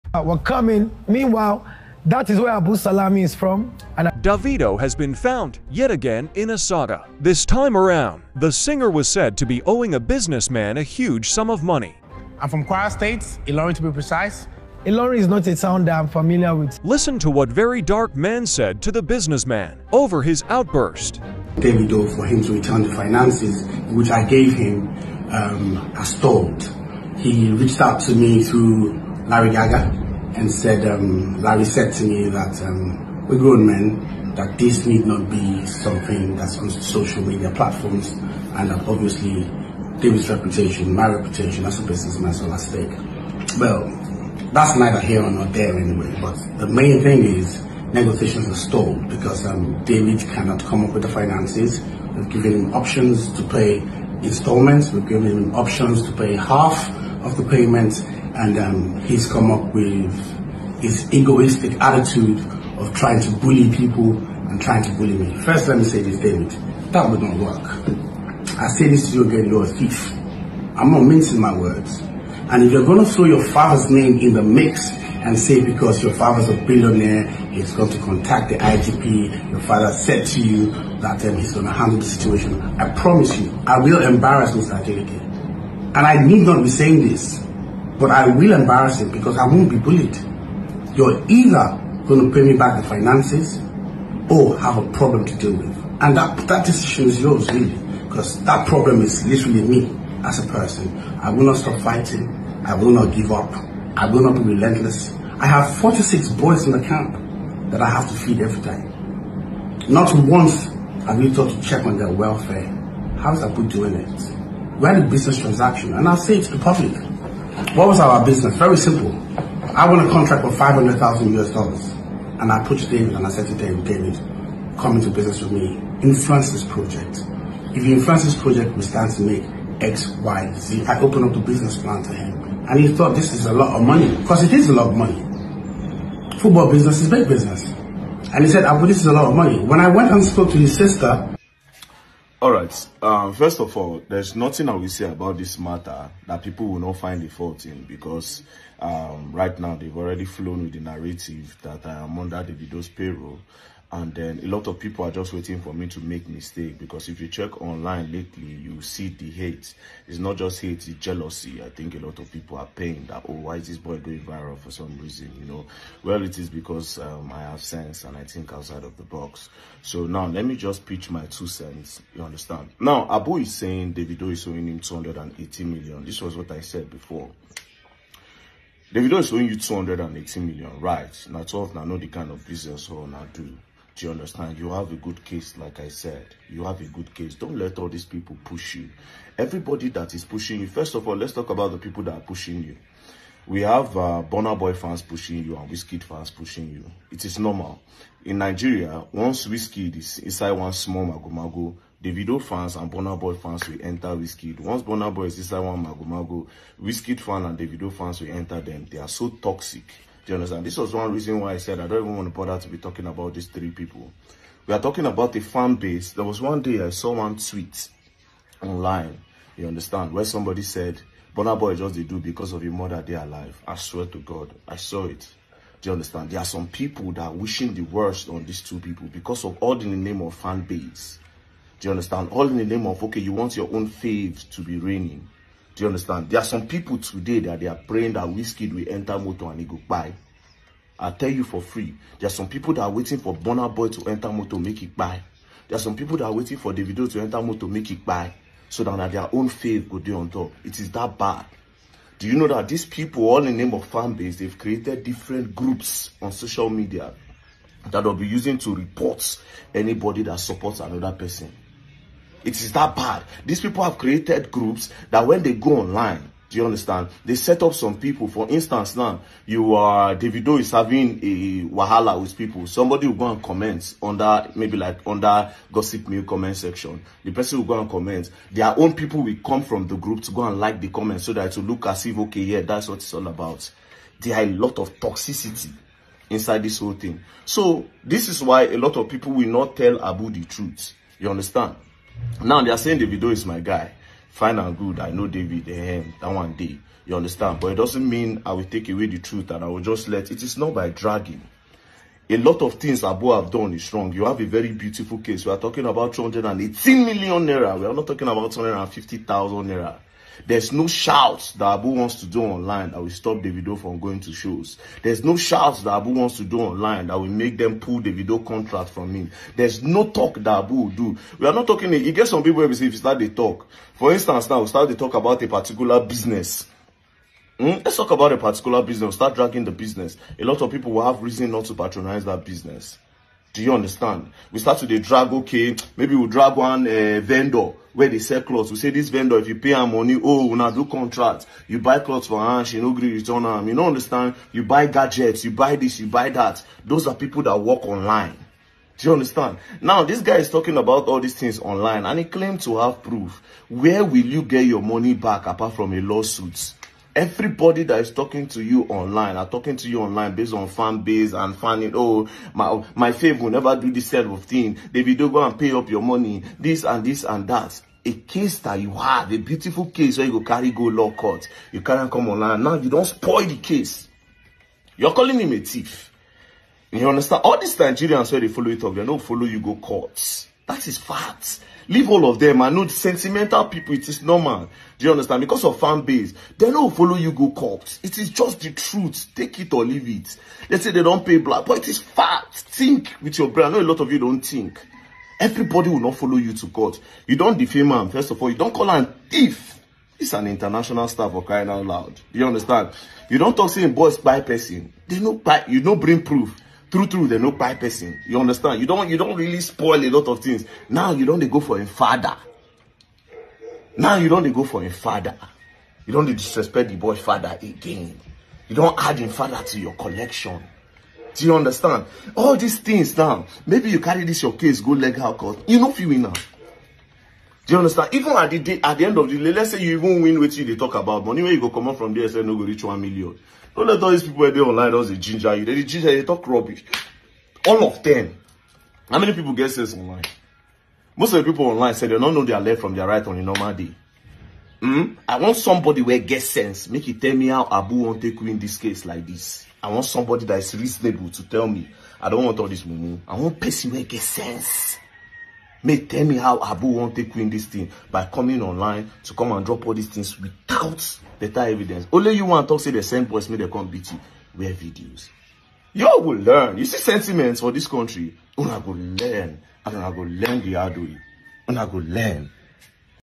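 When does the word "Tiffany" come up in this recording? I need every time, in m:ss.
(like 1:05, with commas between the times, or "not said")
not said.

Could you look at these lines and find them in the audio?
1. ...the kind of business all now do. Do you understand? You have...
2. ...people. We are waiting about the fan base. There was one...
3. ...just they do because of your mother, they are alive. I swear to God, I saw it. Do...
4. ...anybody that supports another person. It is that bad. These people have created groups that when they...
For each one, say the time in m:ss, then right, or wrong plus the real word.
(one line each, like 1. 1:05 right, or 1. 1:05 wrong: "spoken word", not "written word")
1. 3:01 right
2. 3:33 wrong: "talking", not "waiting"
3. 3:41 right
4. 4:19 right.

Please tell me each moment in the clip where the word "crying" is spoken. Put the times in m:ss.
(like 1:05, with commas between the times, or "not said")
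6:41.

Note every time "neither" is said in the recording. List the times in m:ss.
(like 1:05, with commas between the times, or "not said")
0:44.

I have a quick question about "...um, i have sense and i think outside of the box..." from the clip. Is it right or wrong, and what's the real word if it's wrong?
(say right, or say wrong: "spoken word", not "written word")
right.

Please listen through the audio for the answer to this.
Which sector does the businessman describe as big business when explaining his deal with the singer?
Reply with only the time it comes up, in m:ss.
2:16.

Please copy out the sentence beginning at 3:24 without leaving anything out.
Once Burna Boy is inside one Magomago, Wizkid fan and Davido fans will enter them.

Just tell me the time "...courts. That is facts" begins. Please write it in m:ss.
6:19.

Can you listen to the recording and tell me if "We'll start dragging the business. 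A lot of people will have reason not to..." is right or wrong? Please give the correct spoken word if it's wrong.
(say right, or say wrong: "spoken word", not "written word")
right.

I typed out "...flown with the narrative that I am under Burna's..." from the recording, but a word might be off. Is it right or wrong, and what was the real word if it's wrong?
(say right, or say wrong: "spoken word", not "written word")
wrong: "Davido", not "Burna".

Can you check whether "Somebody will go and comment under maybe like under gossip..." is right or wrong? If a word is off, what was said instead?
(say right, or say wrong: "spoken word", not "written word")
right.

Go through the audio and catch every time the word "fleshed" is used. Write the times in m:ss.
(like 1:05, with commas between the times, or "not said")
not said.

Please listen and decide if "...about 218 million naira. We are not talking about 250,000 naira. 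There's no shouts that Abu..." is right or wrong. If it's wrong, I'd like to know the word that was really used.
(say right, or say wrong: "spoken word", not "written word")
right.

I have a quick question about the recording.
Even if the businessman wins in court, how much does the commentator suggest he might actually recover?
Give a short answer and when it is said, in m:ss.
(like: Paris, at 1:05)
1 million, at 7:12.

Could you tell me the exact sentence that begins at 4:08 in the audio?
So that, their own faith go do on top.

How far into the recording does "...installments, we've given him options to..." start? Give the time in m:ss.
0:54.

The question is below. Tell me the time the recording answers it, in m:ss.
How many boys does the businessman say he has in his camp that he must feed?
1:45.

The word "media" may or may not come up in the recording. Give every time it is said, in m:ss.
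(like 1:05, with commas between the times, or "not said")
0:37, 4:16.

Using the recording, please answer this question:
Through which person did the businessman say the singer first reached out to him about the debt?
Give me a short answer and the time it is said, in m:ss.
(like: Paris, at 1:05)
Larry Gaga, at 0:29.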